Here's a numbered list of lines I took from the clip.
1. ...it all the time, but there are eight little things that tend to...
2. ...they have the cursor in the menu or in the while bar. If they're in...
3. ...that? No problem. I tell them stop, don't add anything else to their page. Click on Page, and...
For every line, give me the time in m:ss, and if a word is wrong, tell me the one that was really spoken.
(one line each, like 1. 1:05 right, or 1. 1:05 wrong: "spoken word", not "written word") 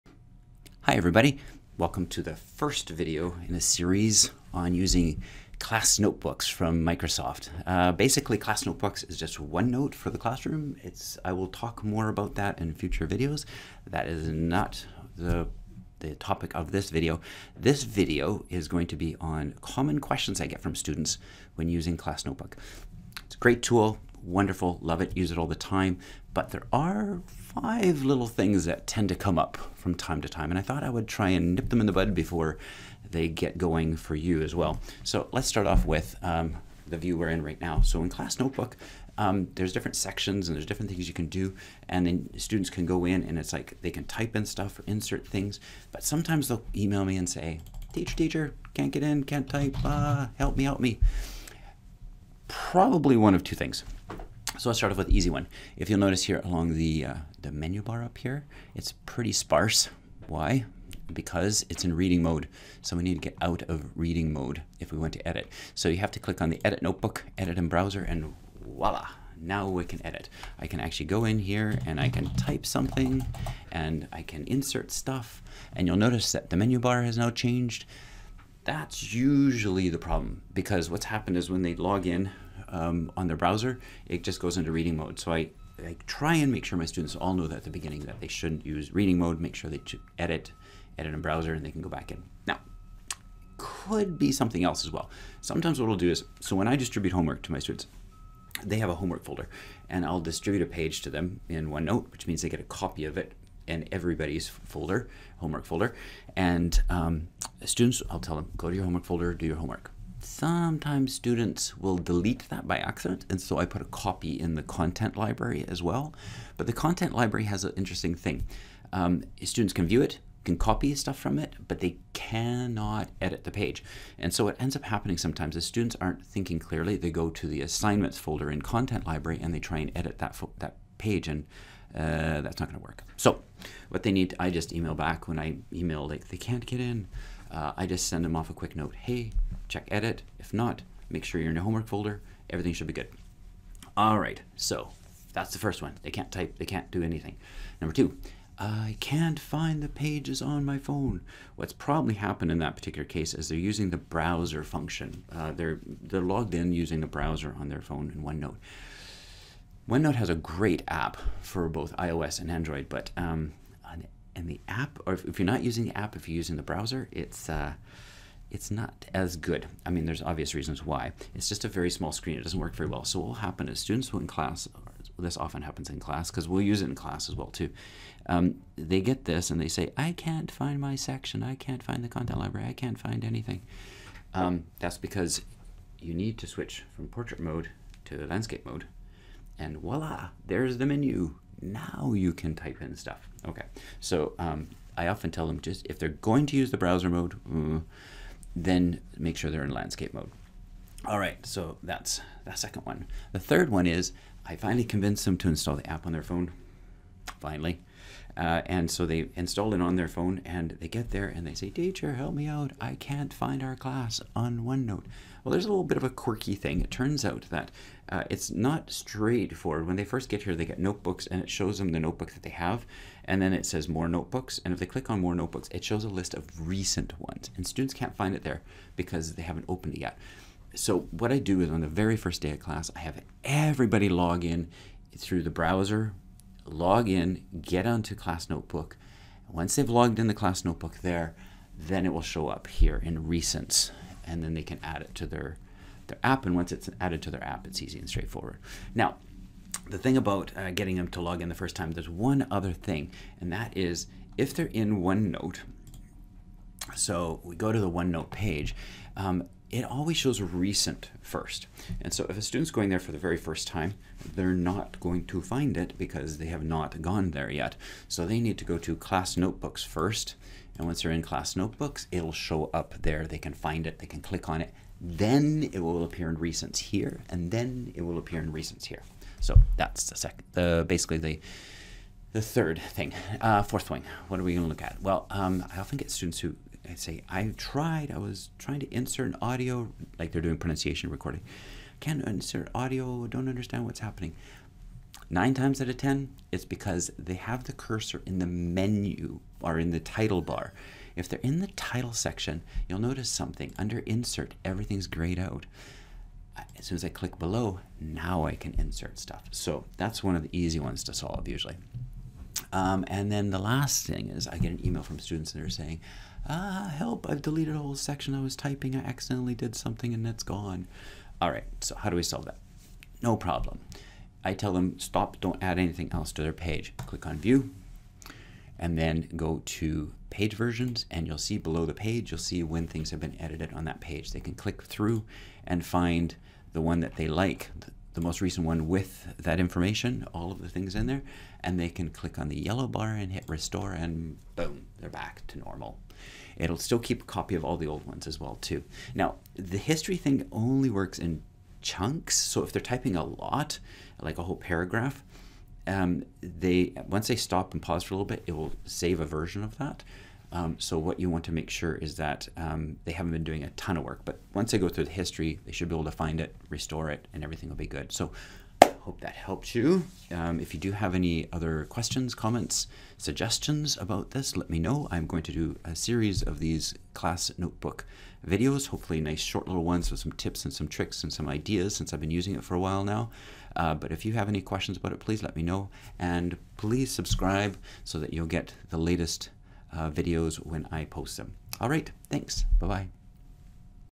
1. 0:25 wrong: "five", not "eight"
2. 4:57 wrong: "title", not "while"
3. 5:22 wrong: "View", not "Page".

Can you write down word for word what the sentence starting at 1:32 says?
Now, could be something else as well.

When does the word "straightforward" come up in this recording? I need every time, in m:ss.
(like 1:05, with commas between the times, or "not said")
3:38, 4:08.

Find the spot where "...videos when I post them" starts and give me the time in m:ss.
6:30.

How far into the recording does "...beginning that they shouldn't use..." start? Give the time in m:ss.
1:27.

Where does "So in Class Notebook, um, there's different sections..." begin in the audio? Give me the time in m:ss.
0:37.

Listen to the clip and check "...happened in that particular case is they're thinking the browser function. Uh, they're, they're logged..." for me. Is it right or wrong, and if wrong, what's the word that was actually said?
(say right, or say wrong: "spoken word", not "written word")
wrong: "using", not "thinking".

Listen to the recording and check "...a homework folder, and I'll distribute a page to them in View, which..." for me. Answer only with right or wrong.
wrong.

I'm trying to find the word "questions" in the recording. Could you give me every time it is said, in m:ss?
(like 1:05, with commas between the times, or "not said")
0:19, 6:11, 6:24.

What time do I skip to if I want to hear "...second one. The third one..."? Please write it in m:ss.
3:22.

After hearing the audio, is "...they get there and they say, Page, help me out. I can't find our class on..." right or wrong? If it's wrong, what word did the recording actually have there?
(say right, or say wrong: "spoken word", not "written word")
wrong: "Teacher", not "Page".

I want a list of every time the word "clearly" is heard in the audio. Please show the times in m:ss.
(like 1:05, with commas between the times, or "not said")
2:06.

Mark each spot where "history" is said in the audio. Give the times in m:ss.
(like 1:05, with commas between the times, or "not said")
5:49, 6:05.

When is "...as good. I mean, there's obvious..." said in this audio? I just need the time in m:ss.
2:49.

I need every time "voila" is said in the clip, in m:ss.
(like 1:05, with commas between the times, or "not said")
1:08, 3:09.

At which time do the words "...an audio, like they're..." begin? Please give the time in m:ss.
4:49.